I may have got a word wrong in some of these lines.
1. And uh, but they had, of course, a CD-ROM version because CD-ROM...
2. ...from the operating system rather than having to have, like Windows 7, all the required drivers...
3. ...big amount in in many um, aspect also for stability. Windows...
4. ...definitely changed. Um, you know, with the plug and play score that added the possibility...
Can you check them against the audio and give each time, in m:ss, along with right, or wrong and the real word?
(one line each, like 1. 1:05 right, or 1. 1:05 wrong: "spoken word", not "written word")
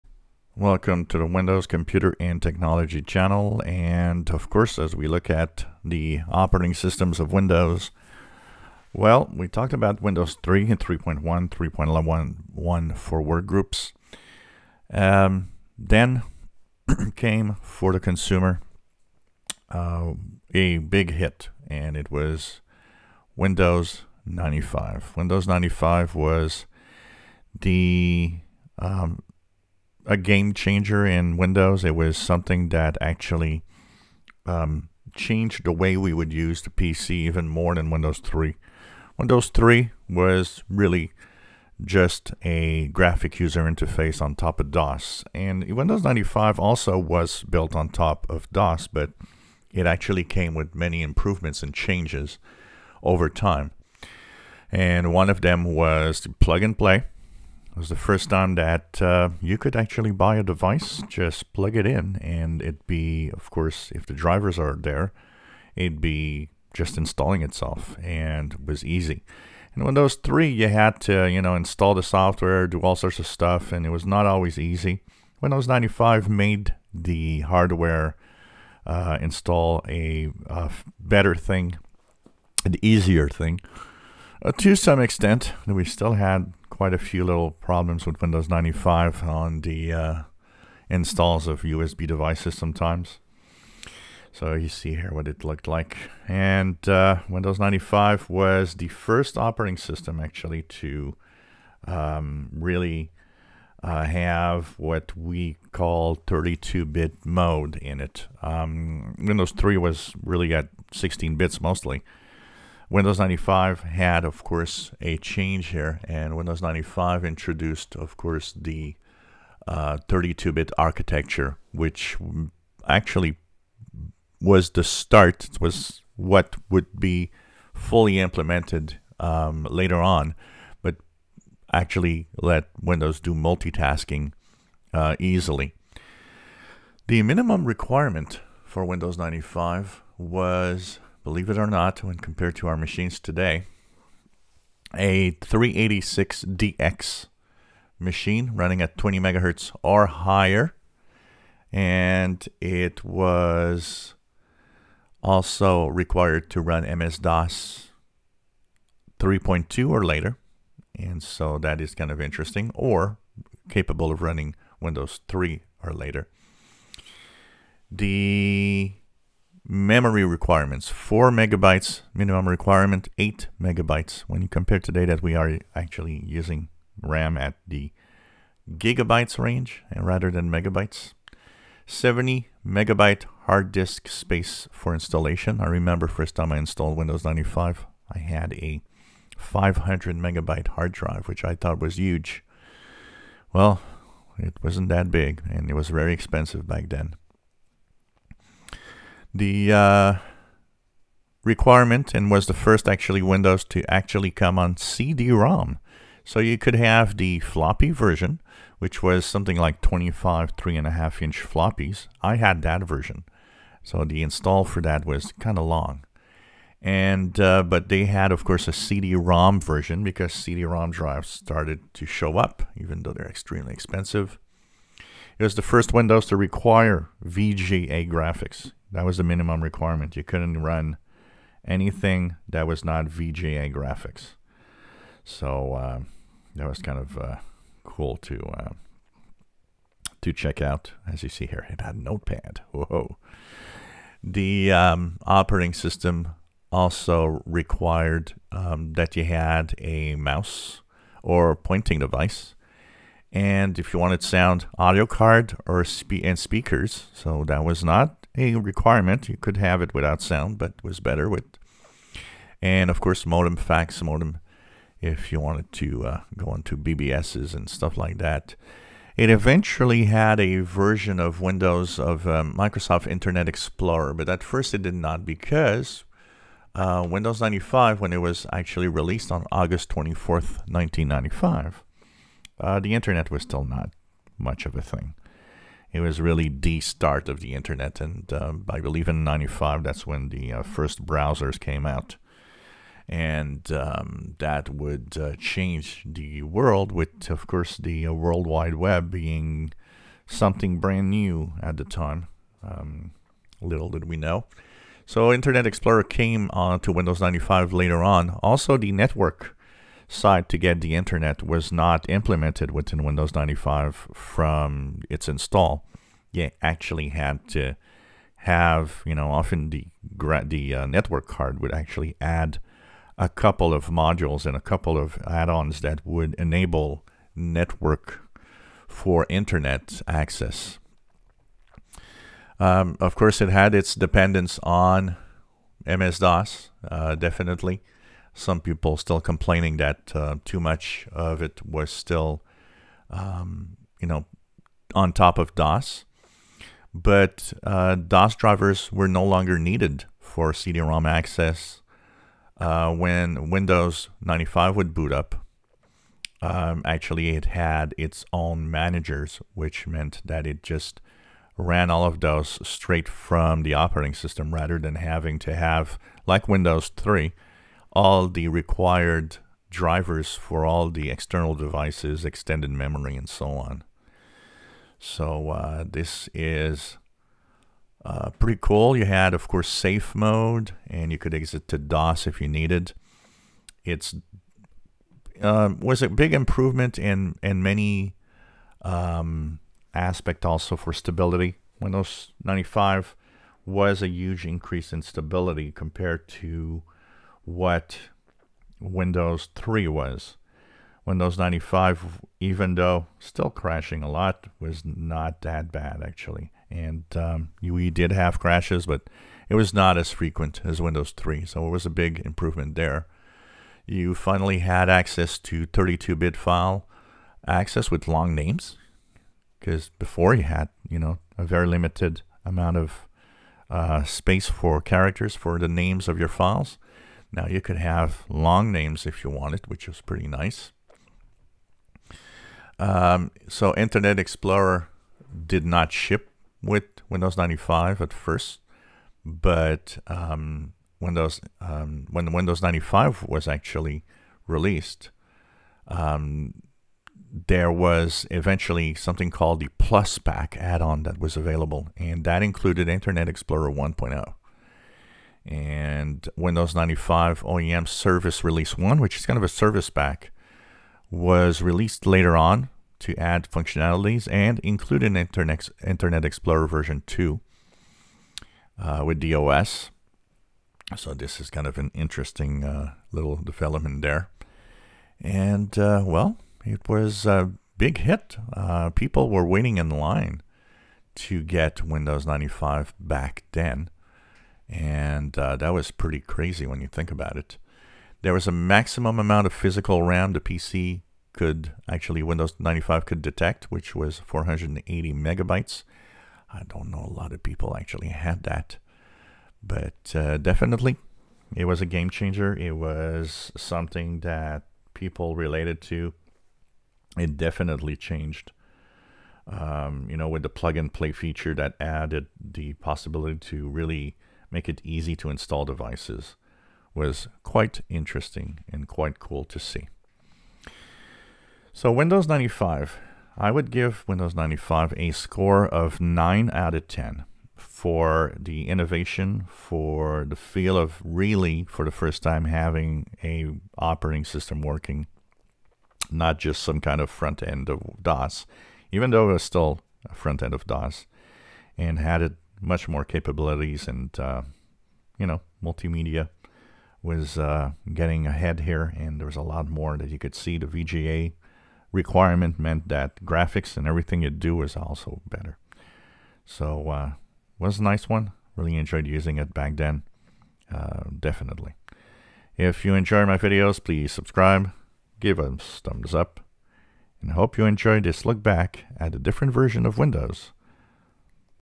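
1. 3:36 right
2. 6:03 wrong: "3", not "7"
3. 6:26 wrong: "improvement", not "amount"
4. 8:27 wrong: "feature", not "score".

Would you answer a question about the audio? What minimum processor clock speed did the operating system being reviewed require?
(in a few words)
20 megahertz.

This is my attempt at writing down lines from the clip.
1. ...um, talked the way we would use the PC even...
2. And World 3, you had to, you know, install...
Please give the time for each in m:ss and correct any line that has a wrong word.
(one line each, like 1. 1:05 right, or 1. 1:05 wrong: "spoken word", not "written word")
1. 0:34 wrong: "changed", not "talked"
2. 1:09 wrong: "Windows", not "World".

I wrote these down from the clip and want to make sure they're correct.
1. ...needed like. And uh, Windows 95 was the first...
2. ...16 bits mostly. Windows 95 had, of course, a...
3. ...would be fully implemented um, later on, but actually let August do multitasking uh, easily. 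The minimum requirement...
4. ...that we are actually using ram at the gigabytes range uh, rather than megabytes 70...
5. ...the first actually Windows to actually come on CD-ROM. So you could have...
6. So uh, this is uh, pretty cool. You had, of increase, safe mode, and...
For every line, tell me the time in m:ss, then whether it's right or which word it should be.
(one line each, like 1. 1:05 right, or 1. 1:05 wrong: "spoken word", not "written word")
1. 1:35 wrong: "looked", not "needed"
2. 1:50 right
3. 2:06 wrong: "Windows", not "August"
4. 2:55 right
5. 3:22 right
6. 6:14 wrong: "course", not "increase".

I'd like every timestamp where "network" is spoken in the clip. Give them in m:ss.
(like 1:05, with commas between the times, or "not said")
5:08, 5:20, 5:27.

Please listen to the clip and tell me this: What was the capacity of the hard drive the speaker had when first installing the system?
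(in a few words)
500 megabytes.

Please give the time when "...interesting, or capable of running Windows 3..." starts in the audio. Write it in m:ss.
2:42.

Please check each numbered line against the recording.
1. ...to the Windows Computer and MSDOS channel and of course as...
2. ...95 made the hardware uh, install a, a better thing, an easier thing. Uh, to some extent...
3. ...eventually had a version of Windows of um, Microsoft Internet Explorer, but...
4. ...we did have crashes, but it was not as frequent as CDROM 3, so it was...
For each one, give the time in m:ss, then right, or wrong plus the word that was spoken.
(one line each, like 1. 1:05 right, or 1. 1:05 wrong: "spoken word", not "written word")
1. 0:01 wrong: "Technology", not "MSDOS"
2. 1:15 right
3. 4:29 right
4. 6:47 wrong: "Windows", not "CDROM".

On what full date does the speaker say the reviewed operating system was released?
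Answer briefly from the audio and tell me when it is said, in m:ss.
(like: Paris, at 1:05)
August 24th, 1995, at 4:39.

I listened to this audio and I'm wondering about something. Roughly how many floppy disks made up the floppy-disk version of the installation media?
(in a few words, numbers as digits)
25.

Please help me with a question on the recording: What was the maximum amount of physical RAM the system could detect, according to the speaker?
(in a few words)
480 megabytes.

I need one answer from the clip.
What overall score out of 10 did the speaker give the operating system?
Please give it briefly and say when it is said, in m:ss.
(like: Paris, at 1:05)
9, at 8:46.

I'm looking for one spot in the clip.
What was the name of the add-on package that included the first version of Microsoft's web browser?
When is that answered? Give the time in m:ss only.
7:29.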